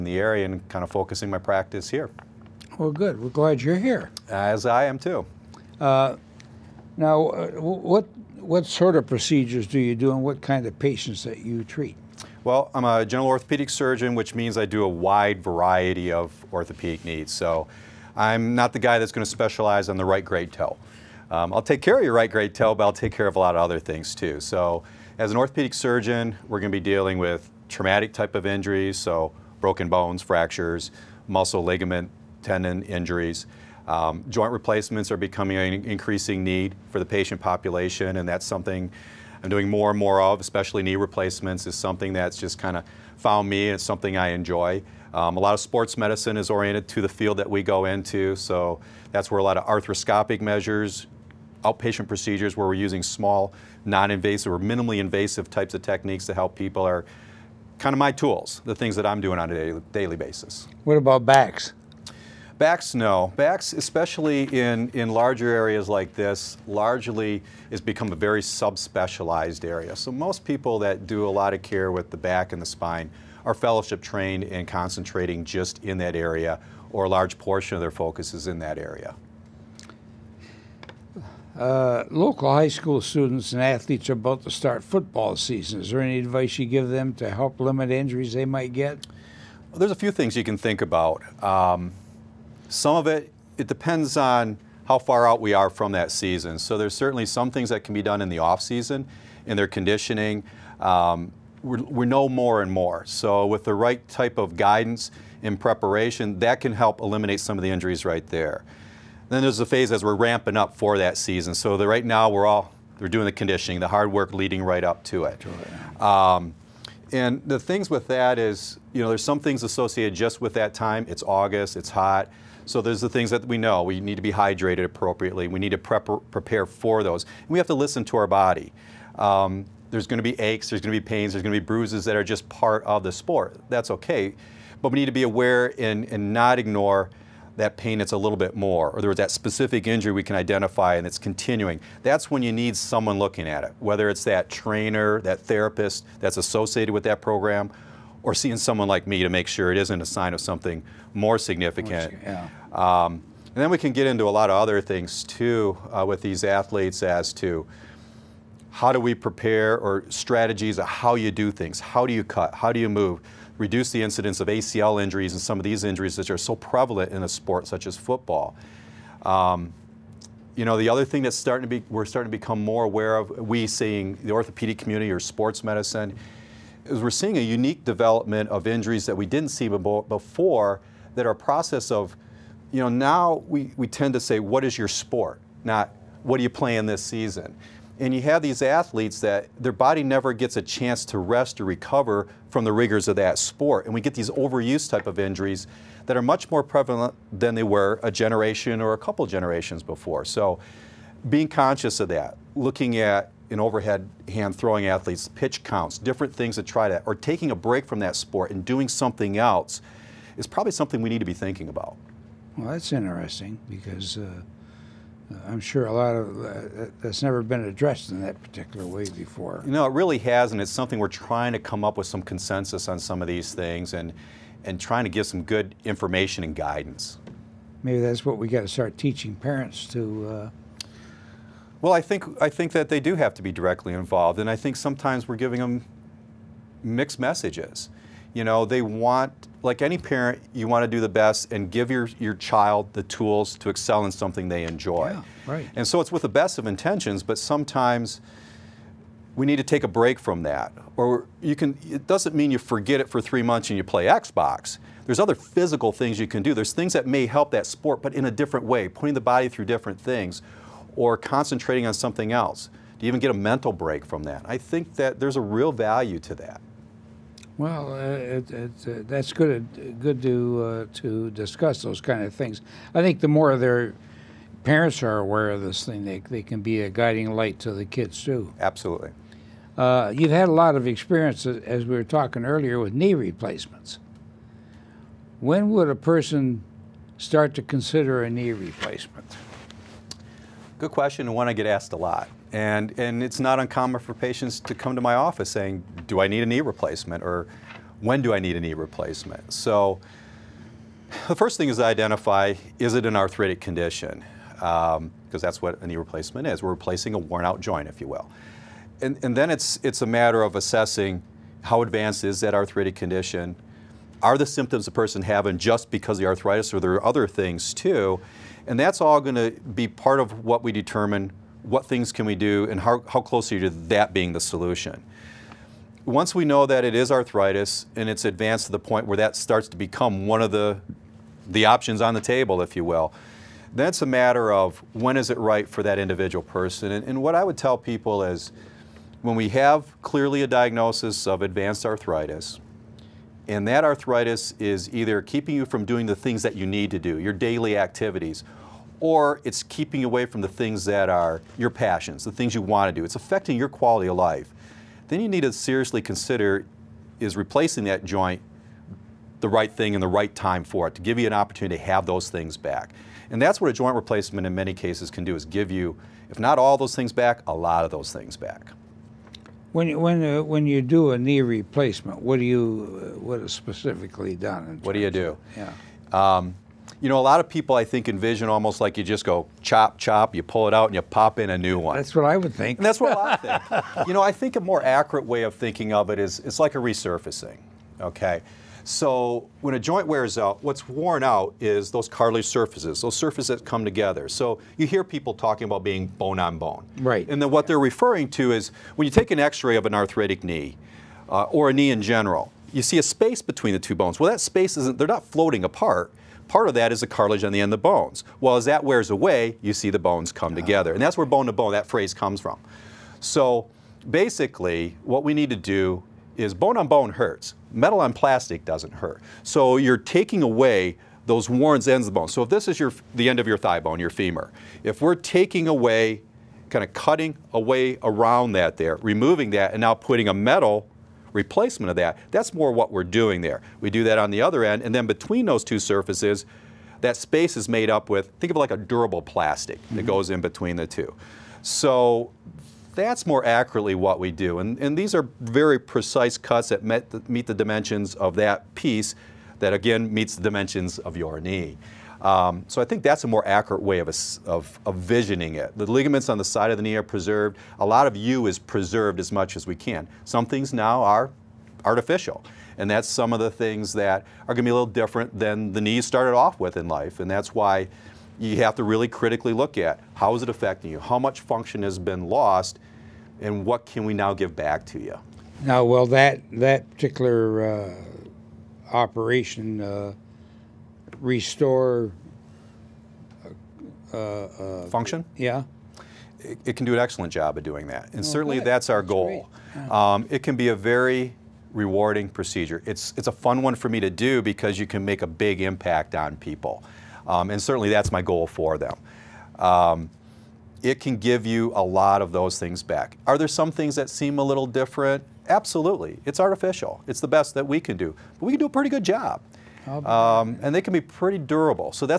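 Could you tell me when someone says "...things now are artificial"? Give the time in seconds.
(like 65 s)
460 s.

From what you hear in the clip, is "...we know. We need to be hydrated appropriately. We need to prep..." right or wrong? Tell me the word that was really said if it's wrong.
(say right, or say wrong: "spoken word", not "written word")
right.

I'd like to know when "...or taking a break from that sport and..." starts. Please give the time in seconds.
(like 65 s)
207 s.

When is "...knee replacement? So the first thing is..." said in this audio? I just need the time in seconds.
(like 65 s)
298 s.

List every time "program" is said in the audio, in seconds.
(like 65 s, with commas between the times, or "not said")
147 s.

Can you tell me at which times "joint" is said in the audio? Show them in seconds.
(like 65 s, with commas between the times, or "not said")
34 s, 307 s, 358 s, 363 s, 389 s.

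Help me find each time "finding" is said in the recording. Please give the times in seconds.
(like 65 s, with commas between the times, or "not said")
not said.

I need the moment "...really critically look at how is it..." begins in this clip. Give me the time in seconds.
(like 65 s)
468 s.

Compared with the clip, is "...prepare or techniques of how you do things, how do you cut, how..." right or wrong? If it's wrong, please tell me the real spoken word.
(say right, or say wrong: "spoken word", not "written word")
wrong: "strategies", not "techniques".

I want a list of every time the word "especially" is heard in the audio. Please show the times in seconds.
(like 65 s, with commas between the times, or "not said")
40 s, 63 s.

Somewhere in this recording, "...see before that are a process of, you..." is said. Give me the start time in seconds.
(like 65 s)
179 s.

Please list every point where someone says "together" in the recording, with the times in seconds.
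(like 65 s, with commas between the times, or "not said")
393 s, 410 s.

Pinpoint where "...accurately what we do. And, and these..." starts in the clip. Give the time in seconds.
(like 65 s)
443 s.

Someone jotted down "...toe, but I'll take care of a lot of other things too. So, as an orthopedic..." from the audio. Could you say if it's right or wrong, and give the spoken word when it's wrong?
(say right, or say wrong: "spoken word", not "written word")
right.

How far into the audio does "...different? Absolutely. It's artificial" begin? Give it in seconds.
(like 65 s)
504 s.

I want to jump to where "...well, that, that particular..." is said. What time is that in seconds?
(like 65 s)
475 s.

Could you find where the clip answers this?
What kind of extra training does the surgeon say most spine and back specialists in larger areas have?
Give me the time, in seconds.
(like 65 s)
73 s.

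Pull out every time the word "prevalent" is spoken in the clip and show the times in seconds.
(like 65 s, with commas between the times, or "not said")
166 s, 196 s.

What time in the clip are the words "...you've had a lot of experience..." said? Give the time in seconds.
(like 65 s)
280 s.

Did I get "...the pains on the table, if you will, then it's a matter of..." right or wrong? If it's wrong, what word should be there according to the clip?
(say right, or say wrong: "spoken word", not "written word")
wrong: "options", not "pains".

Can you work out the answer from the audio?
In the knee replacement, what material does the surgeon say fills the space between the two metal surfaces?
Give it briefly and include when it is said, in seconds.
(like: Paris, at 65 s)
durable plastic, at 438 s.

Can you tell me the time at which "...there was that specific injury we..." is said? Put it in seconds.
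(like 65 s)
139 s.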